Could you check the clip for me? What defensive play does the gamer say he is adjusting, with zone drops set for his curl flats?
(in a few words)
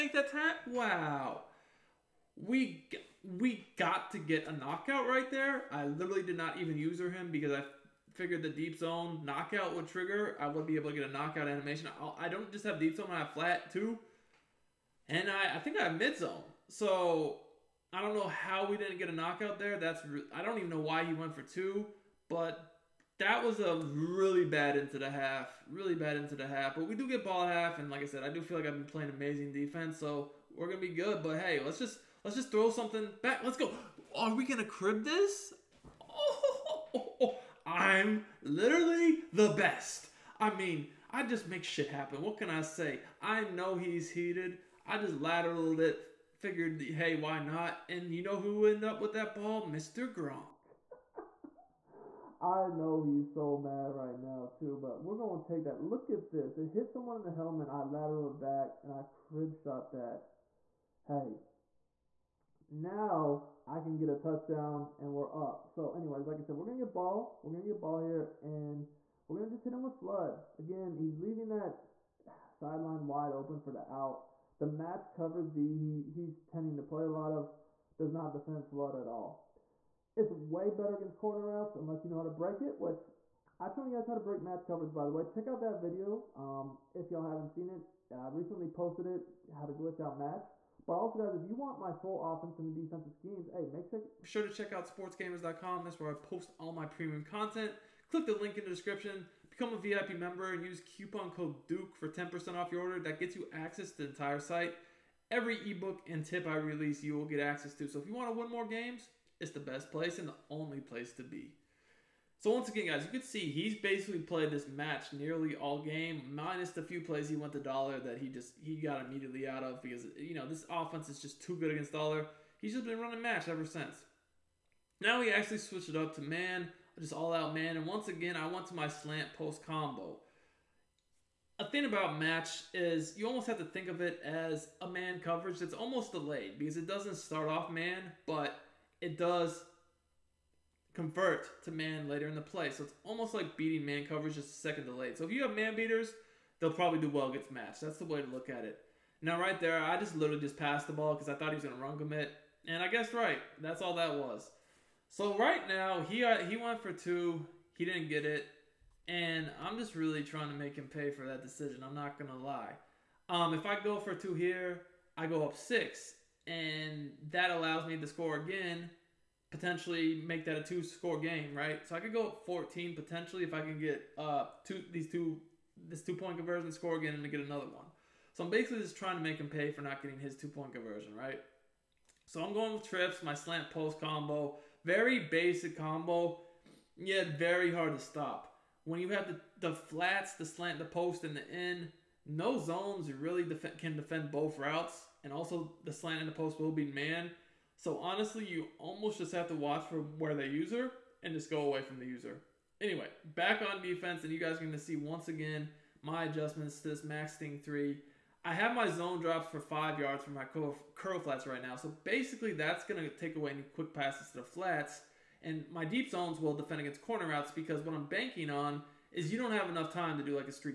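Max Sting 3.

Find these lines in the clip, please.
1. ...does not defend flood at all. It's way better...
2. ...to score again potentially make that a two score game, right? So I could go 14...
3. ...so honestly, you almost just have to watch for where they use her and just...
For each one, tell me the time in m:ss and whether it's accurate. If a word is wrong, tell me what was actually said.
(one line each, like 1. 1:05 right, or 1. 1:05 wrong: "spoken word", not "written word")
1. 1:17 right
2. 2:47 right
3. 3:17 right.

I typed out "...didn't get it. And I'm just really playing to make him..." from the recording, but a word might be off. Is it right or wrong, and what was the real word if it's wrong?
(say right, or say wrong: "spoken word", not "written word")
wrong: "trying", not "playing".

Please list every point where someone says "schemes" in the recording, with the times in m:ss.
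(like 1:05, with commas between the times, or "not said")
1:33.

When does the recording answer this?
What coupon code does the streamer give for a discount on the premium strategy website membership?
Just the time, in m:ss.
1:41.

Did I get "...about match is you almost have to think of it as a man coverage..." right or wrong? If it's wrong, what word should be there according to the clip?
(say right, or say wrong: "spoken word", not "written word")
right.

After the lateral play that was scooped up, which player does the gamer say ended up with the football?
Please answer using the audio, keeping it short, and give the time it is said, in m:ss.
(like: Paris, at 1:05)
Gronk, at 0:49.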